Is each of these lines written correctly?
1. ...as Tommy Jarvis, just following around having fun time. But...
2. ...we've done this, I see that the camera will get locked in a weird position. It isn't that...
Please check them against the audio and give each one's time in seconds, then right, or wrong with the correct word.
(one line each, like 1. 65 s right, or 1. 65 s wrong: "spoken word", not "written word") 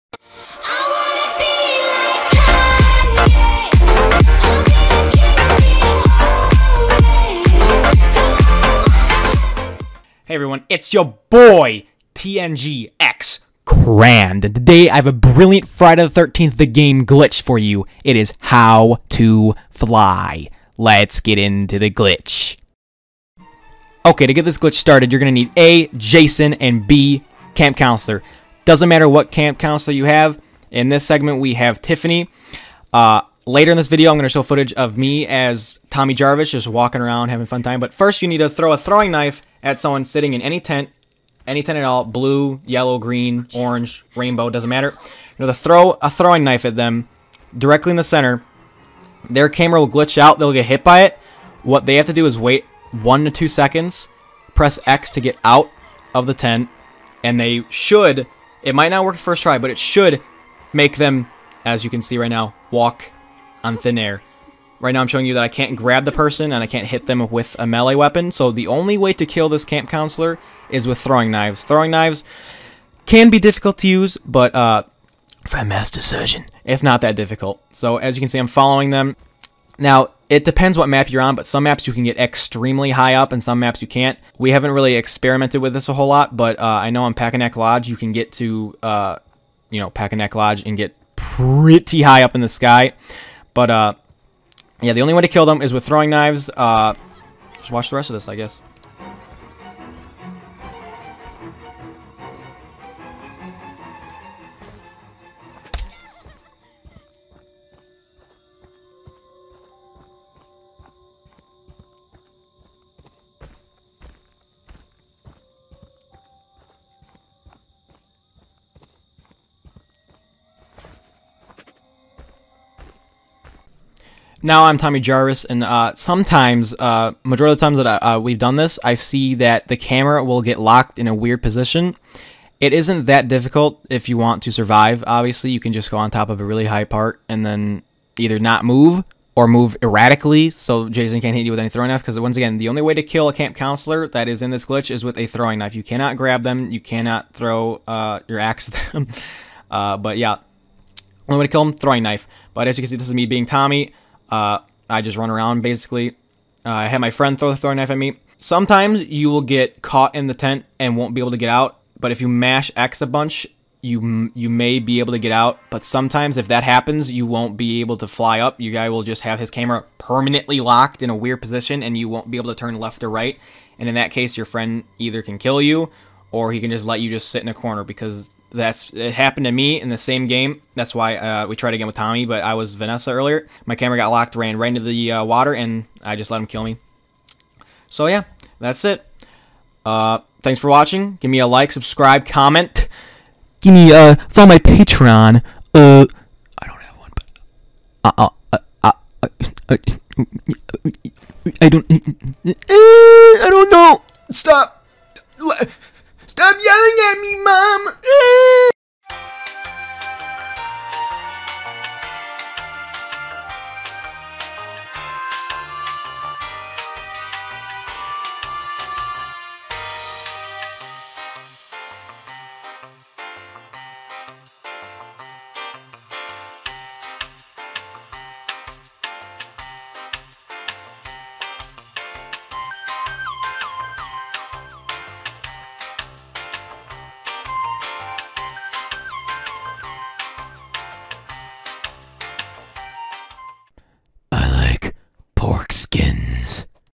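1. 35 s wrong: "walking", not "following"
2. 128 s right.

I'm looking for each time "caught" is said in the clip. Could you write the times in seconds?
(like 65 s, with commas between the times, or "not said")
159 s.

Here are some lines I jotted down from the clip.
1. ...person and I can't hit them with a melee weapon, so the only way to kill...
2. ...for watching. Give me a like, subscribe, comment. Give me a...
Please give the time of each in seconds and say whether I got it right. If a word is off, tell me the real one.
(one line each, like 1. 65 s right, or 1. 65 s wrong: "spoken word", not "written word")
1. 66 s right
2. 190 s right.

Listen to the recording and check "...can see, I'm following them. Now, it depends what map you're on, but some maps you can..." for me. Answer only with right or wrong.
right.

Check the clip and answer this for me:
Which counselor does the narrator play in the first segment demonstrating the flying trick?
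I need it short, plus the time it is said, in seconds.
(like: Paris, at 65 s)
Tiffany, at 31 s.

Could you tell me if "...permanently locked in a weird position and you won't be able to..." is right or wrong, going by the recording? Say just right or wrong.
right.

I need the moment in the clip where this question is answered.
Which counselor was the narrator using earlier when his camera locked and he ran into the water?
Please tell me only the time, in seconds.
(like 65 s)
182 s.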